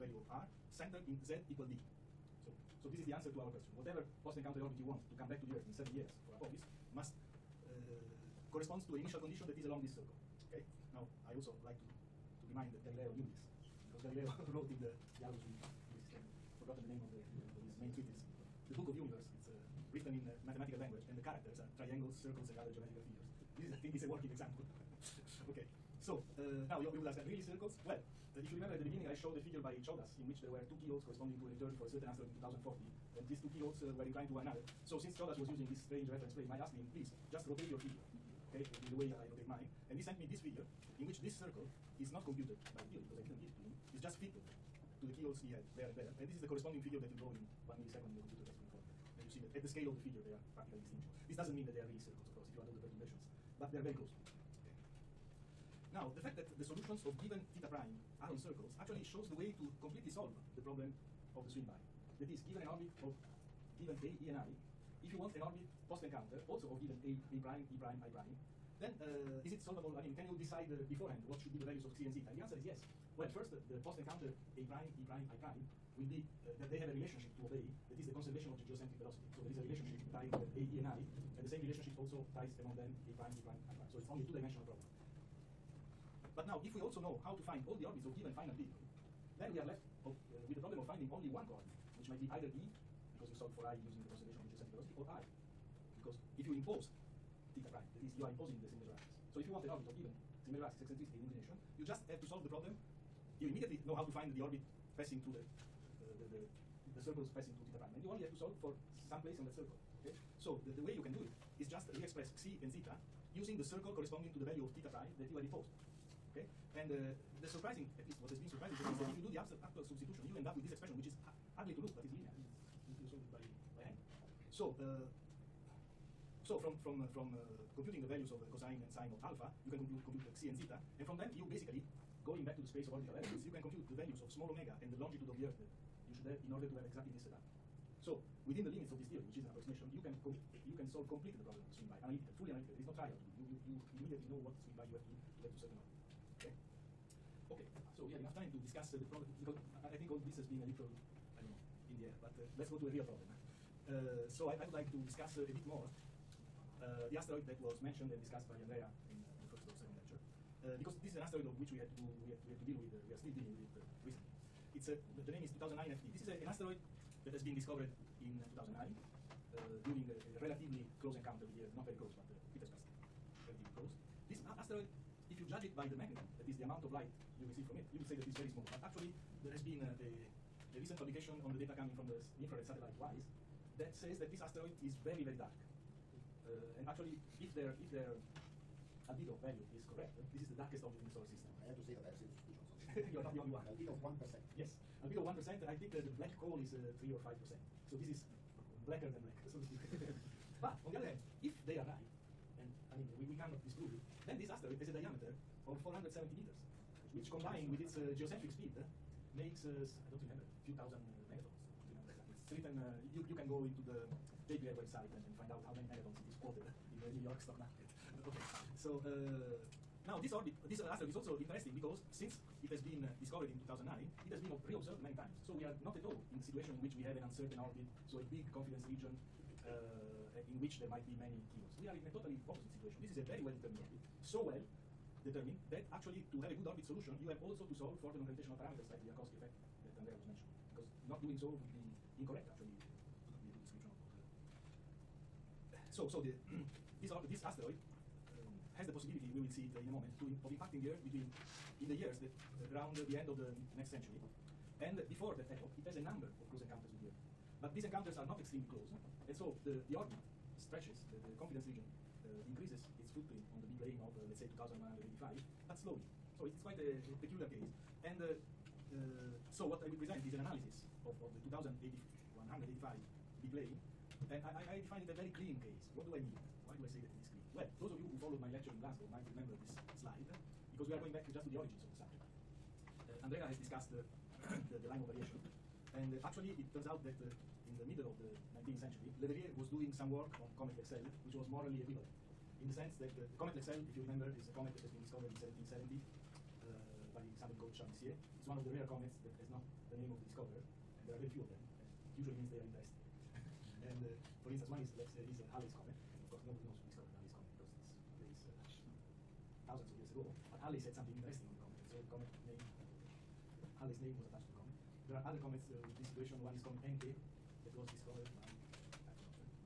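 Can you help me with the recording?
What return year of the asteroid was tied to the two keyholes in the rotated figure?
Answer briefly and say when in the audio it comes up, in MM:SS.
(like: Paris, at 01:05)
2040, at 00:32.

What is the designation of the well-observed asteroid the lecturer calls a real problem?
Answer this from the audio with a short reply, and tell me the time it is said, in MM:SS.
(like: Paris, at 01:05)
2009 FD, at 02:45.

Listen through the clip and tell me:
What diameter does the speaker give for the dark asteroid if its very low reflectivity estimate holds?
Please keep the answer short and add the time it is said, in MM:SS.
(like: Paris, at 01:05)
470 meters, at 03:25.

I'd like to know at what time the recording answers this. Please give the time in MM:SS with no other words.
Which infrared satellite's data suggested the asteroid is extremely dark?
03:02.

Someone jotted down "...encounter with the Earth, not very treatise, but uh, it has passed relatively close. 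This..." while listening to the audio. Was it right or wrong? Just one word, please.
wrong.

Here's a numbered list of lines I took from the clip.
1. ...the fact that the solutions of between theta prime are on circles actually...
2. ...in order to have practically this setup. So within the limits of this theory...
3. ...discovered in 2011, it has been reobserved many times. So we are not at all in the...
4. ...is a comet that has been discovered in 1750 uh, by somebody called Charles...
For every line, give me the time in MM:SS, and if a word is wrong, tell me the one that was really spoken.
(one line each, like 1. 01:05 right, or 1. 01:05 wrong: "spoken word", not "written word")
1. 00:56 wrong: "given", not "between"
2. 02:16 wrong: "exactly", not "practically"
3. 03:43 wrong: "2009", not "2011"
4. 04:54 wrong: "1770", not "1750".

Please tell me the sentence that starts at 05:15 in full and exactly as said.
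There are other comets uh, with this situation.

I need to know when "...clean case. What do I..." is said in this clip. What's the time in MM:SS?
04:35.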